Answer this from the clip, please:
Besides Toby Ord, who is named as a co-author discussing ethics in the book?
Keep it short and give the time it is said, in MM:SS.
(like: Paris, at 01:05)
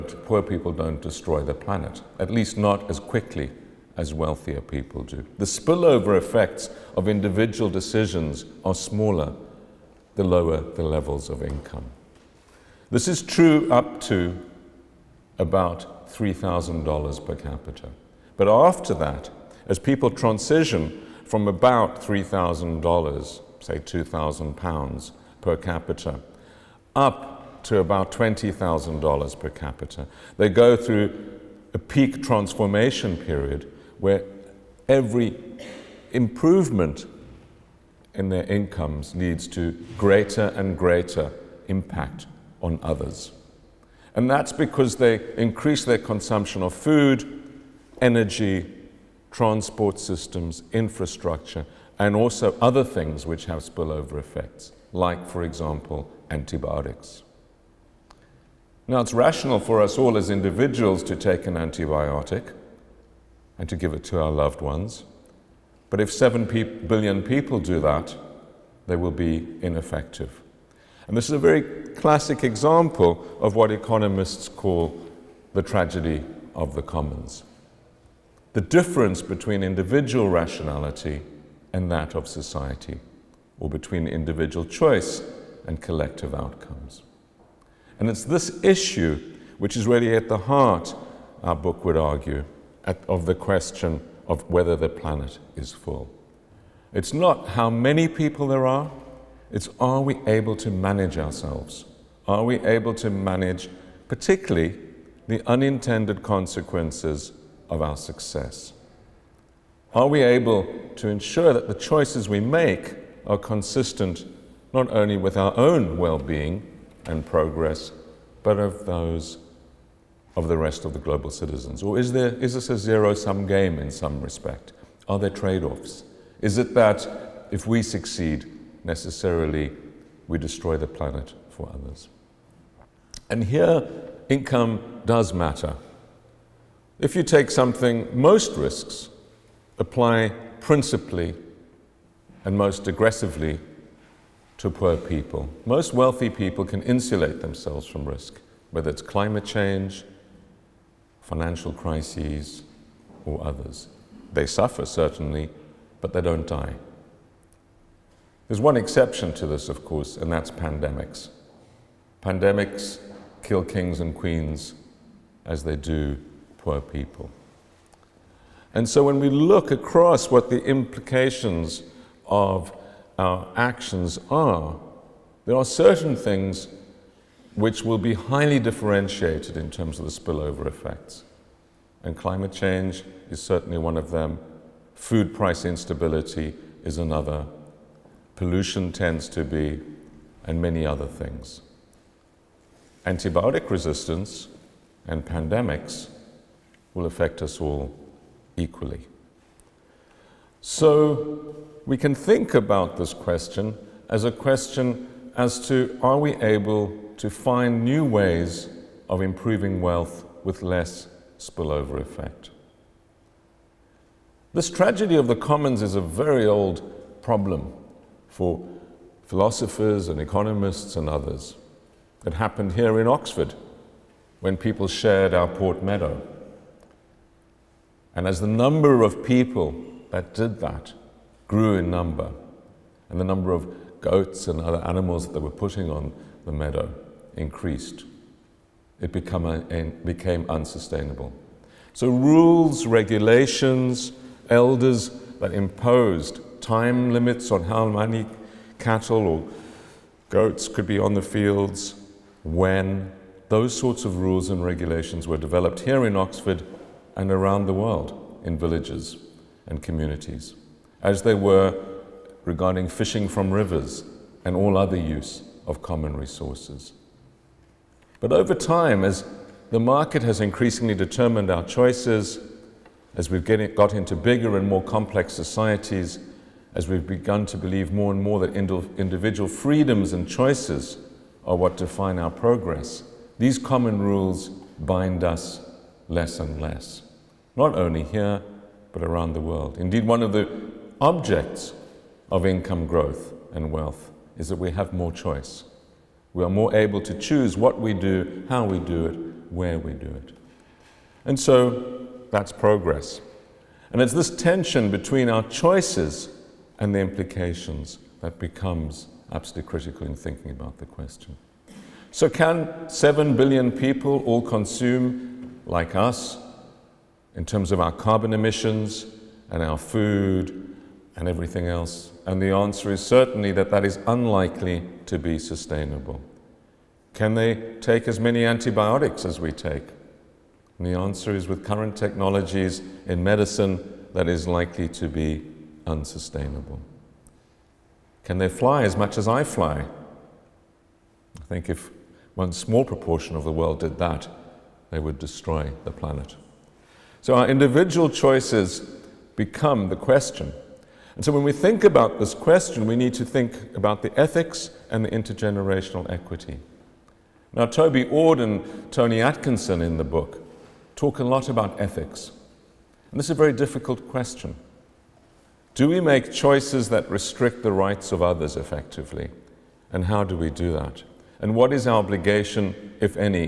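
Tony Atkinson, at 05:58.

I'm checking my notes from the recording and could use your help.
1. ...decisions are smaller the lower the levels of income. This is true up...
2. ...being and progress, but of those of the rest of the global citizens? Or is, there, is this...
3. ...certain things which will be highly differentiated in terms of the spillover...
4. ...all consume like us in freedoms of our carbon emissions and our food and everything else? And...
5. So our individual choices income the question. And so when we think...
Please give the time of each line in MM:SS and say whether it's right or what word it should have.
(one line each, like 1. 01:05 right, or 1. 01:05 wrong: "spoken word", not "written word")
1. 00:07 right
2. 01:56 right
3. 02:55 right
4. 05:14 wrong: "terms", not "freedoms"
5. 05:47 wrong: "become", not "income".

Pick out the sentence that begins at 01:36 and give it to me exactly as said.
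It's not how many people there are, it's are we able to manage ourselves?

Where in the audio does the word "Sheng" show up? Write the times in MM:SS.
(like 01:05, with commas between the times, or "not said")
not said.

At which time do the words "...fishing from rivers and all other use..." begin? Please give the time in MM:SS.
04:22.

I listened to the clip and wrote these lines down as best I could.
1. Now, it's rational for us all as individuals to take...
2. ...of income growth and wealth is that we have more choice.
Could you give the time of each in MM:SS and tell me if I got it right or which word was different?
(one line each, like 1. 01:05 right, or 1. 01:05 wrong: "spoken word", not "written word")
1. 00:58 right
2. 04:52 right.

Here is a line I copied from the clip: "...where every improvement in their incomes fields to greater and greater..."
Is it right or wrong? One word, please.
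wrong.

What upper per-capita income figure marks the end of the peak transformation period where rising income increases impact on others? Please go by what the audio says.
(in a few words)
$20,000.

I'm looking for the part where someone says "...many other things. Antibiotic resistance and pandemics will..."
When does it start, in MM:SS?
03:10.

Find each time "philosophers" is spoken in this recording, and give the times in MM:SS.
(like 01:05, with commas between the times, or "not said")
03:39.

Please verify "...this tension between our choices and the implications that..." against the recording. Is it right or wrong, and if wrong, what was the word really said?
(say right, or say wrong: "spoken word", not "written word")
right.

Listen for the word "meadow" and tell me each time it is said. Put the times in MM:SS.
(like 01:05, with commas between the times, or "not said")
03:45, 03:56.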